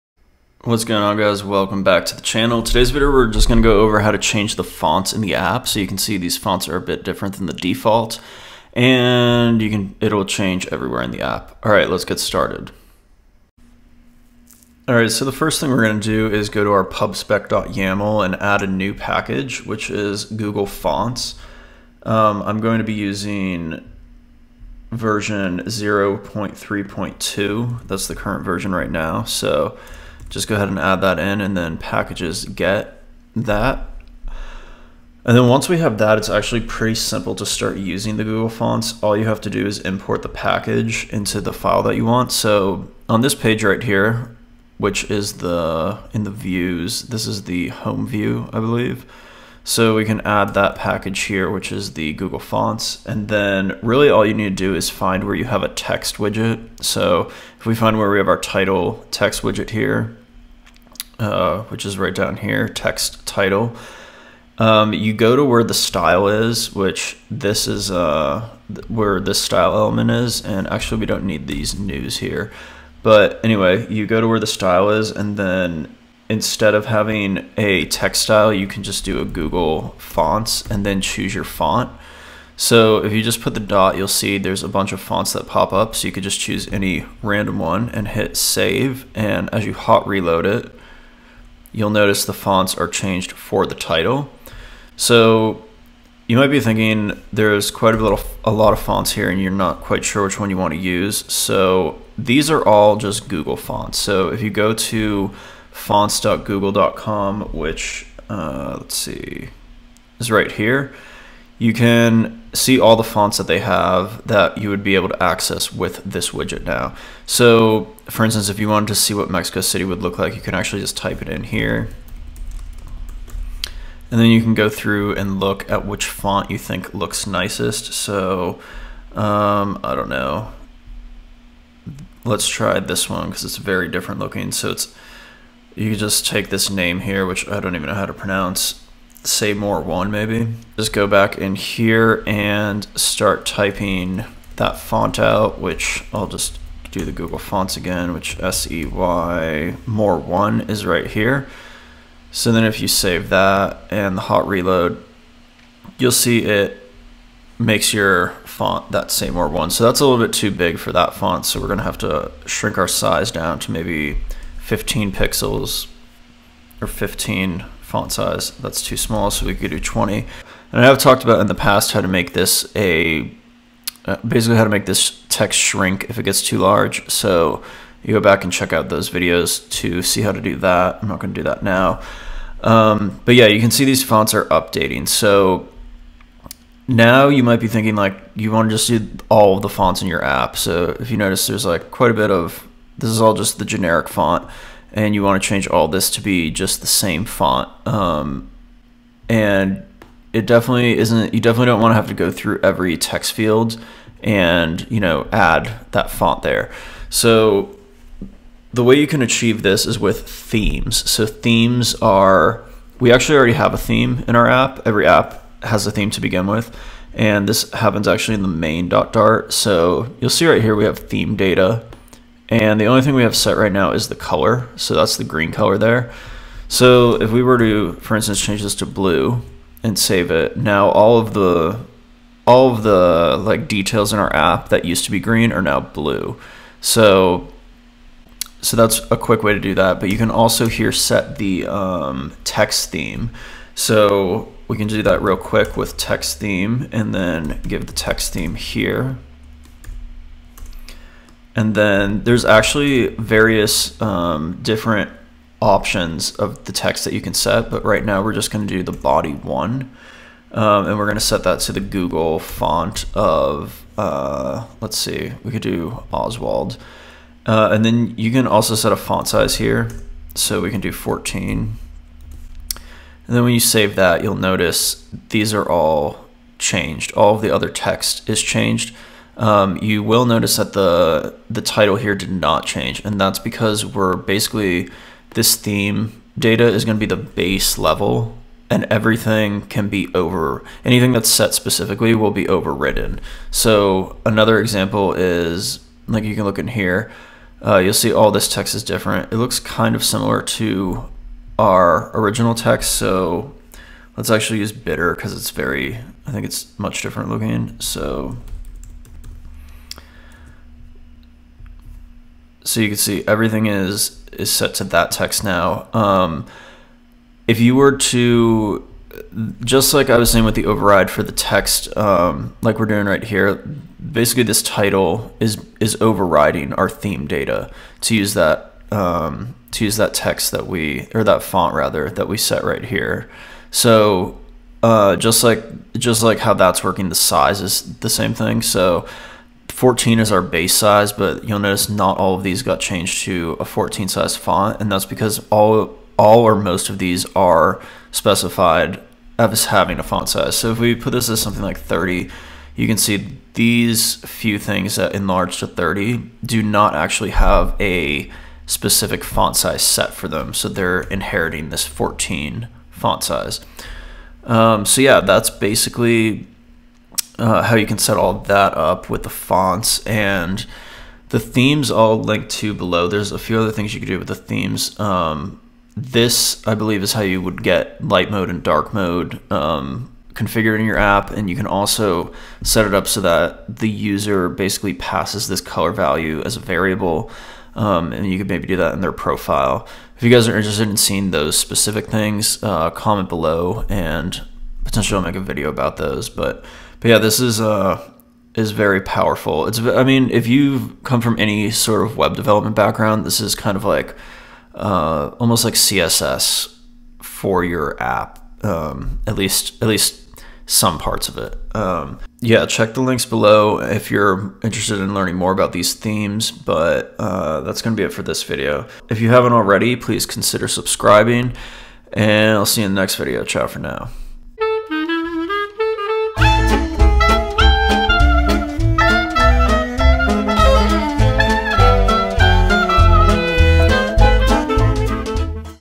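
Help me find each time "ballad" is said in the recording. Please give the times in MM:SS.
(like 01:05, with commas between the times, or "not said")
not said.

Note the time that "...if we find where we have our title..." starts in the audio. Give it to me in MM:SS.
00:57.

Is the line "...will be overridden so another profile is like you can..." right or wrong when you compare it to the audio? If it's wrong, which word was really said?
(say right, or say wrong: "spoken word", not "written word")
wrong: "example", not "profile".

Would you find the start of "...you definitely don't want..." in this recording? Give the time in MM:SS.
03:21.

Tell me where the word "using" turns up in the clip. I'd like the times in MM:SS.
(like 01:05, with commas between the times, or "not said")
00:22, 00:37.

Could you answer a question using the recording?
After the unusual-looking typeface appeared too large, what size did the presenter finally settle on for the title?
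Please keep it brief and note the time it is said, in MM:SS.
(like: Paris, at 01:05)
20, at 02:49.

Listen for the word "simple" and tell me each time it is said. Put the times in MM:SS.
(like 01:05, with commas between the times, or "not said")
00:36.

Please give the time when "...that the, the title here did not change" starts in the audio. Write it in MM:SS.
04:40.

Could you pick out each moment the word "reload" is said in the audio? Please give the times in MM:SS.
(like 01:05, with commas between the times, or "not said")
01:30, 02:34.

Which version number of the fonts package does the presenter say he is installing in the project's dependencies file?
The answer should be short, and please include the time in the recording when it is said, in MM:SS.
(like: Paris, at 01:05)
0.3.2, at 00:25.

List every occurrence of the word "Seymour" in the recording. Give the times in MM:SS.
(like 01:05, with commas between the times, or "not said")
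02:19, 02:39.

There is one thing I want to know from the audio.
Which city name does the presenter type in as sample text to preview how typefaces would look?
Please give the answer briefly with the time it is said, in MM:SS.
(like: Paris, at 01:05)
Mexico City, at 01:59.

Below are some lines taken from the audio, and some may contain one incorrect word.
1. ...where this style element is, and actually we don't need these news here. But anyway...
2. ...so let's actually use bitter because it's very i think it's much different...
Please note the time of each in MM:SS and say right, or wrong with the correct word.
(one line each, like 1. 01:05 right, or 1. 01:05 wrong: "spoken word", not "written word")
1. 01:08 right
2. 05:02 right.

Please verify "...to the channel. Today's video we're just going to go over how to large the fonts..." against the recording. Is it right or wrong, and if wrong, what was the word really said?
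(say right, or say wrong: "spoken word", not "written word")
wrong: "change", not "large".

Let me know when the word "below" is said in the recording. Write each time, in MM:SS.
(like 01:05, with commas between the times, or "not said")
06:12, 06:33, 06:53.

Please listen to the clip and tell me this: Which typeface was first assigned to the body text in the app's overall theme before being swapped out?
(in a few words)
Oswald.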